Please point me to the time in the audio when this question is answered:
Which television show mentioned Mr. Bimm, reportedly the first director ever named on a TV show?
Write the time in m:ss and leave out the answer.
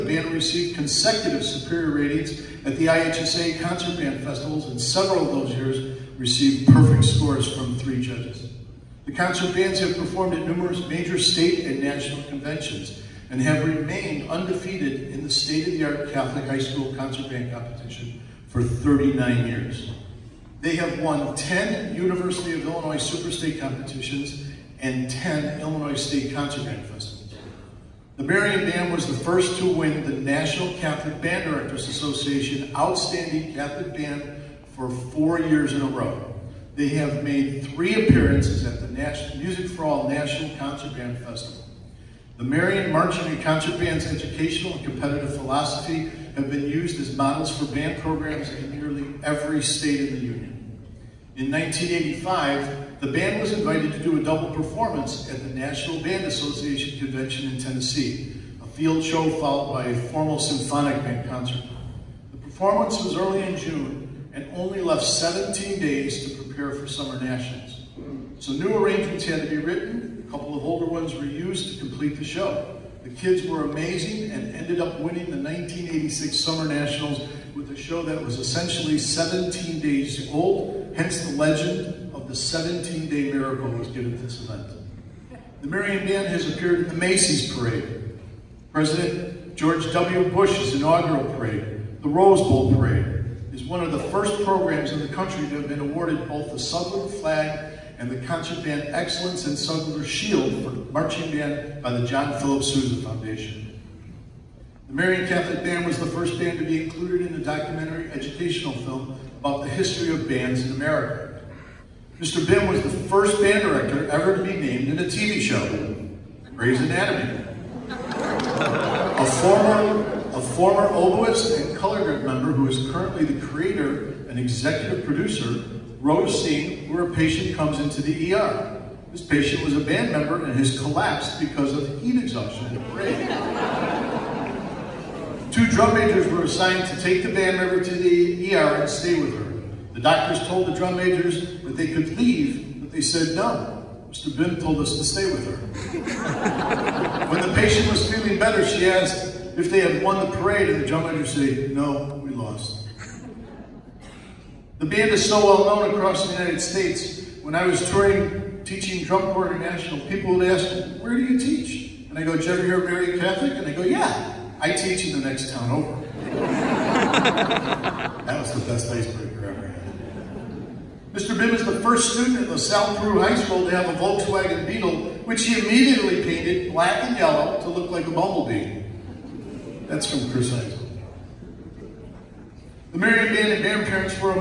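1:56.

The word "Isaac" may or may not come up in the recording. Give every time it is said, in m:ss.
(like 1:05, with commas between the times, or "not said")
3:00.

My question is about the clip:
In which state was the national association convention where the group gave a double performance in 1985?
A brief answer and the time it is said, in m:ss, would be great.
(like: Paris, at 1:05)
Tennessee, at 0:57.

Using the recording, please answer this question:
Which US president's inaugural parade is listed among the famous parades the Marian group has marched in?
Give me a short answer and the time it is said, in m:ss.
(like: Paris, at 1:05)
George W. Bush, at 1:29.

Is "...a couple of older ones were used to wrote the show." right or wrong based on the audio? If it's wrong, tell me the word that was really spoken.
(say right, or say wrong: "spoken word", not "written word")
wrong: "complete", not "wrote".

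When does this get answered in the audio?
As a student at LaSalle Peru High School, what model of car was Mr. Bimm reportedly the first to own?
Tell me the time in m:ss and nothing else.
2:53.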